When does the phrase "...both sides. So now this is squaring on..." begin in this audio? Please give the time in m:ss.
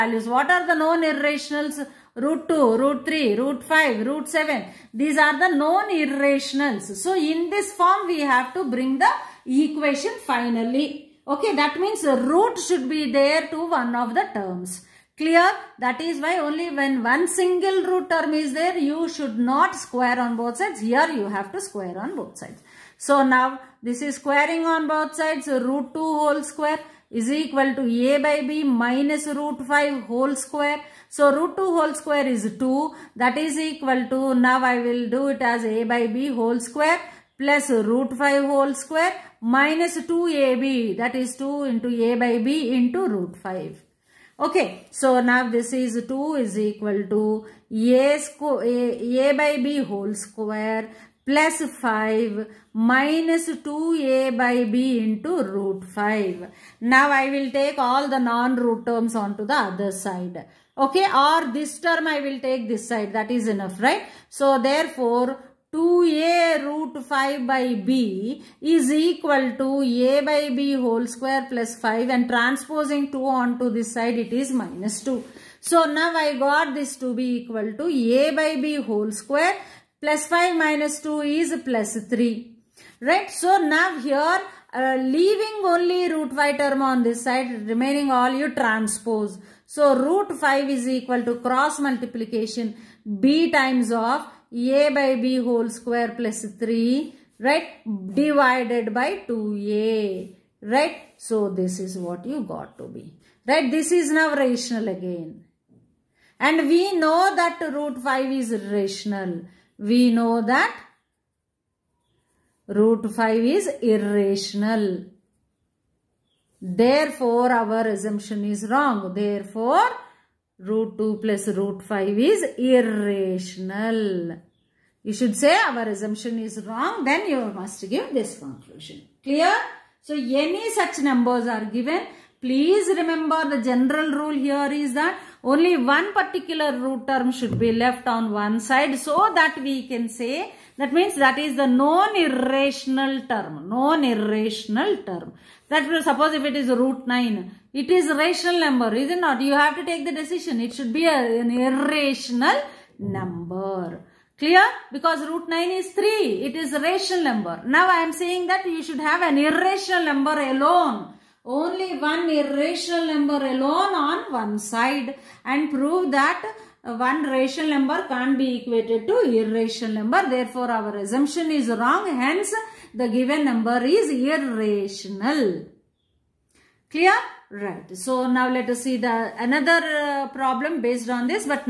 0:22.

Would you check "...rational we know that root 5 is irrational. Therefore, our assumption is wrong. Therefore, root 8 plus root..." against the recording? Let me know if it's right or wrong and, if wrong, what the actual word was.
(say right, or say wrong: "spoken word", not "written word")
wrong: "2", not "8".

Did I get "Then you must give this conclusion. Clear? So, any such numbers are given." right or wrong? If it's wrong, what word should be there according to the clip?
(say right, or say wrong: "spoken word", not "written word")
right.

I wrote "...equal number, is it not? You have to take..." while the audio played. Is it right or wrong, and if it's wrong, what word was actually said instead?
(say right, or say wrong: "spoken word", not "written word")
wrong: "rational", not "equal".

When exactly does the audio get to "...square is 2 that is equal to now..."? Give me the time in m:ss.
0:31.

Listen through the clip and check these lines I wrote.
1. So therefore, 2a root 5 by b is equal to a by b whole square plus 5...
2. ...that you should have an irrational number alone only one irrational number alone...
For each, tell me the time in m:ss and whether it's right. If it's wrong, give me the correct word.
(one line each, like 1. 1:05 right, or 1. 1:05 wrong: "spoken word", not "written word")
1. 1:04 right
2. 2:38 right.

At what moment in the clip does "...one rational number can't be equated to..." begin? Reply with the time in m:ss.
2:46.